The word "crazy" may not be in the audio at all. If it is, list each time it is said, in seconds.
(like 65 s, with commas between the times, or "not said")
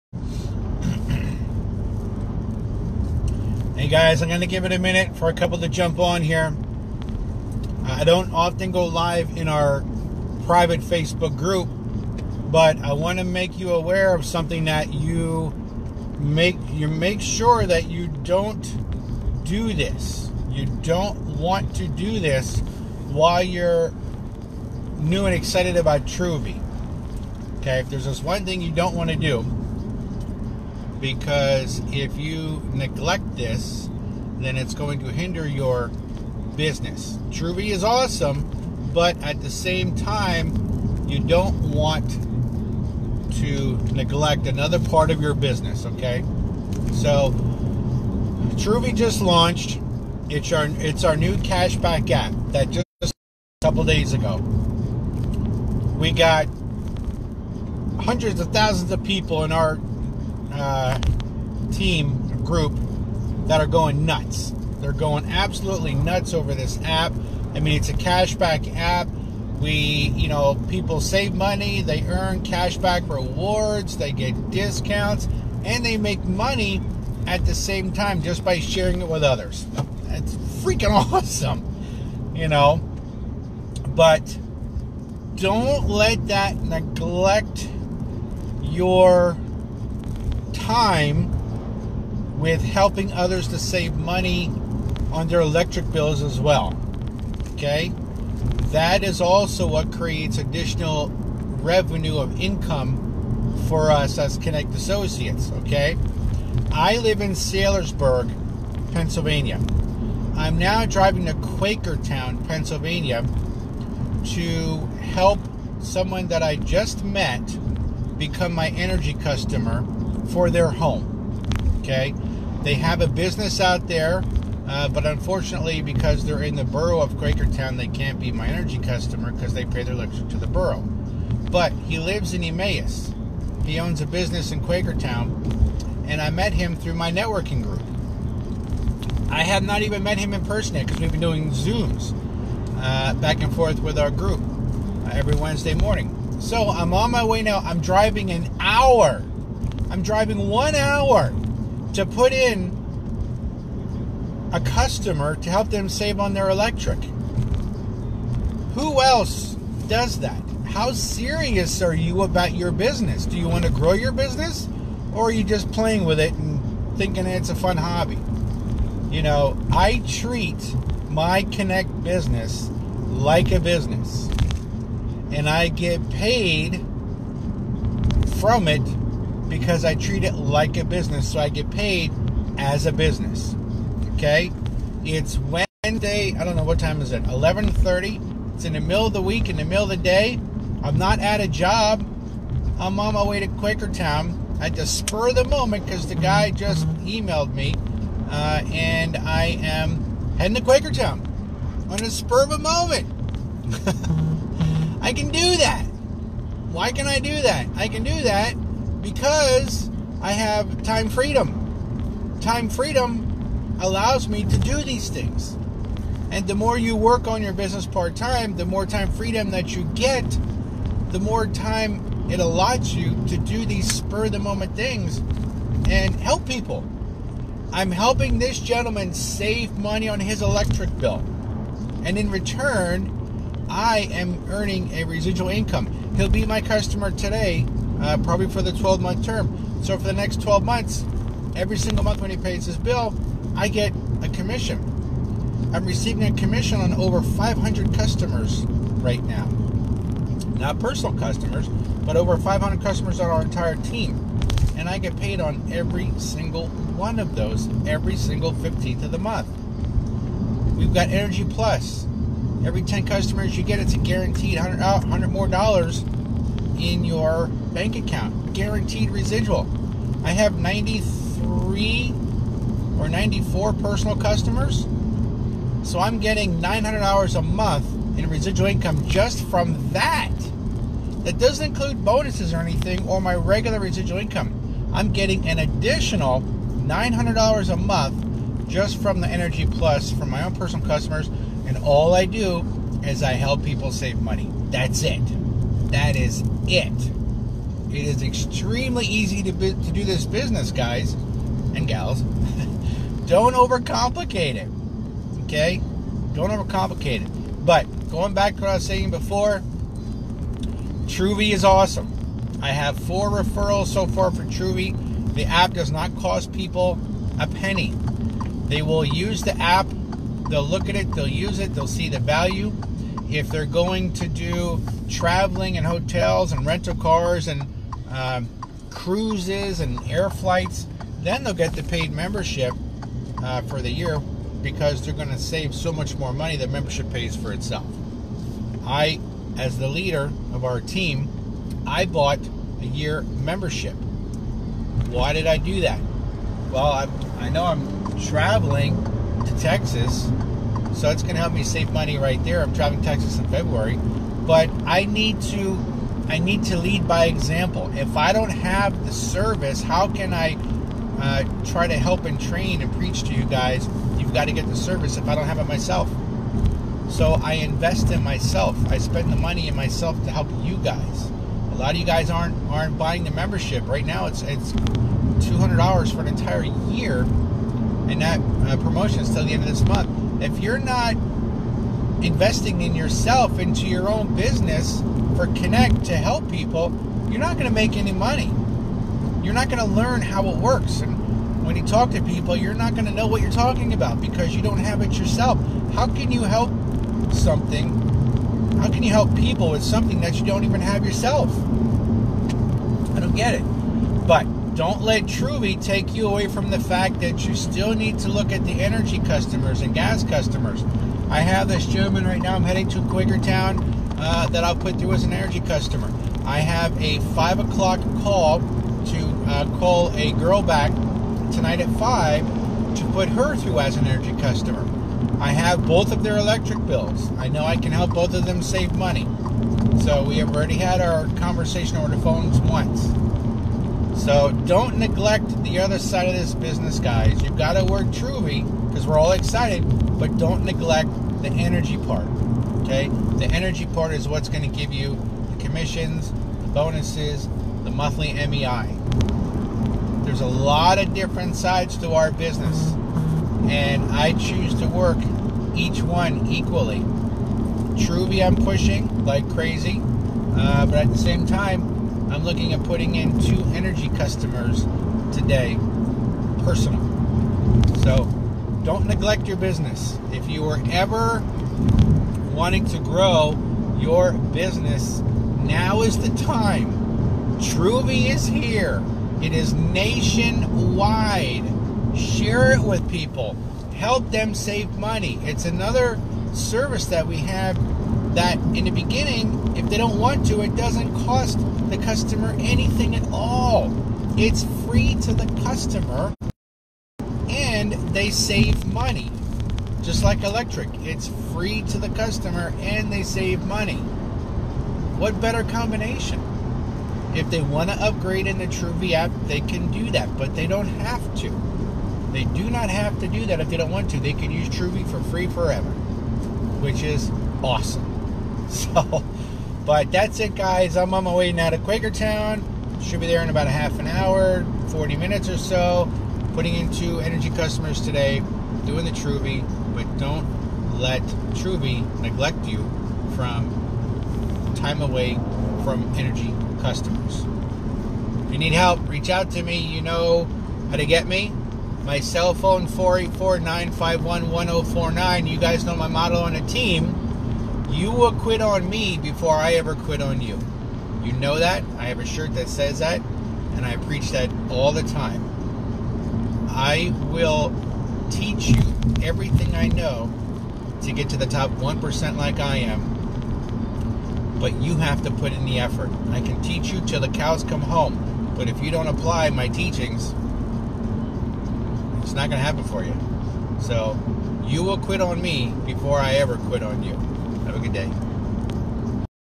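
459 s.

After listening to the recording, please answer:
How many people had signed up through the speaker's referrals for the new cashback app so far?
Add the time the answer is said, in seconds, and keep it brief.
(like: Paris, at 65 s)
4, at 312 s.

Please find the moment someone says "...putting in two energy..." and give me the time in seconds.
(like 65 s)
462 s.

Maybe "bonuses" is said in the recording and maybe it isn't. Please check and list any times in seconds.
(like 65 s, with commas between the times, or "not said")
282 s, 446 s.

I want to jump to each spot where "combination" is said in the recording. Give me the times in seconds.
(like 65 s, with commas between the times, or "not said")
505 s.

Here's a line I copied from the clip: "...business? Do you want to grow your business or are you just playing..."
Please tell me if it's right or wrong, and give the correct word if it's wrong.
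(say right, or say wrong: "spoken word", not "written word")
right.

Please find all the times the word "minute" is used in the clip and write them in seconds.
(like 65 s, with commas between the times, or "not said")
4 s, 525 s.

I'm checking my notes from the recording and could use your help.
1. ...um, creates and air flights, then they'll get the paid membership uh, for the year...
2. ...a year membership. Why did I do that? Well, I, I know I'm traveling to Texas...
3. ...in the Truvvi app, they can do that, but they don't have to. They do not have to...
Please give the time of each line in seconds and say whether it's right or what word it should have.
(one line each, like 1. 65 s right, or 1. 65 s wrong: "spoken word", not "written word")
1. 328 s wrong: "cruises", not "creates"
2. 342 s right
3. 508 s right.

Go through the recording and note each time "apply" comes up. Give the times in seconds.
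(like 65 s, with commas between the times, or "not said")
569 s.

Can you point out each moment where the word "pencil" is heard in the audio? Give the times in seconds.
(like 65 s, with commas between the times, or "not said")
not said.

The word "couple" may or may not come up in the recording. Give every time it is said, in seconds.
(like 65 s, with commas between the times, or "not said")
5 s, 53 s.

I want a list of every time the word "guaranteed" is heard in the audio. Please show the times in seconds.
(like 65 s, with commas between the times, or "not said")
263 s, 268 s.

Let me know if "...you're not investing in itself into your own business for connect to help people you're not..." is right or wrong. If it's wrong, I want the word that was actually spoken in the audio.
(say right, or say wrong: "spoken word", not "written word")
wrong: "yourself", not "itself".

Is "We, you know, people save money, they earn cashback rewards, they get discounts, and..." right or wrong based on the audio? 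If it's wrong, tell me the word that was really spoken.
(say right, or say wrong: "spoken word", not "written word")
right.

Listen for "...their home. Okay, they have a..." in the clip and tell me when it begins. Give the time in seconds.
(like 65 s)
120 s.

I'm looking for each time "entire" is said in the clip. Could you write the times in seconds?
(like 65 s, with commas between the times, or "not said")
253 s, 376 s.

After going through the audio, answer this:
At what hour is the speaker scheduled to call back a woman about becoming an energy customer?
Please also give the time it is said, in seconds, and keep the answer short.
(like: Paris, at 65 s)
5 o'clock, at 417 s.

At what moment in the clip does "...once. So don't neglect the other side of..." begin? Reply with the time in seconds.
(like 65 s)
432 s.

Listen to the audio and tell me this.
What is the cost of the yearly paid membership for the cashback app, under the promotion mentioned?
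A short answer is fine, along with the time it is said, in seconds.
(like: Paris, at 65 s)
$200, at 374 s.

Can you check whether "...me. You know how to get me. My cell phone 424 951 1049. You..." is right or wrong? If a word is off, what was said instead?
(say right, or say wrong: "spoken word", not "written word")
wrong: "484", not "424".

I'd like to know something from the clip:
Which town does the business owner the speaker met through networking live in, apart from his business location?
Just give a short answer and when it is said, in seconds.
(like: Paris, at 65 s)
Emmaus, at 132 s.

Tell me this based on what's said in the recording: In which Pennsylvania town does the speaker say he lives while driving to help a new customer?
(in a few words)
Saylorsburg.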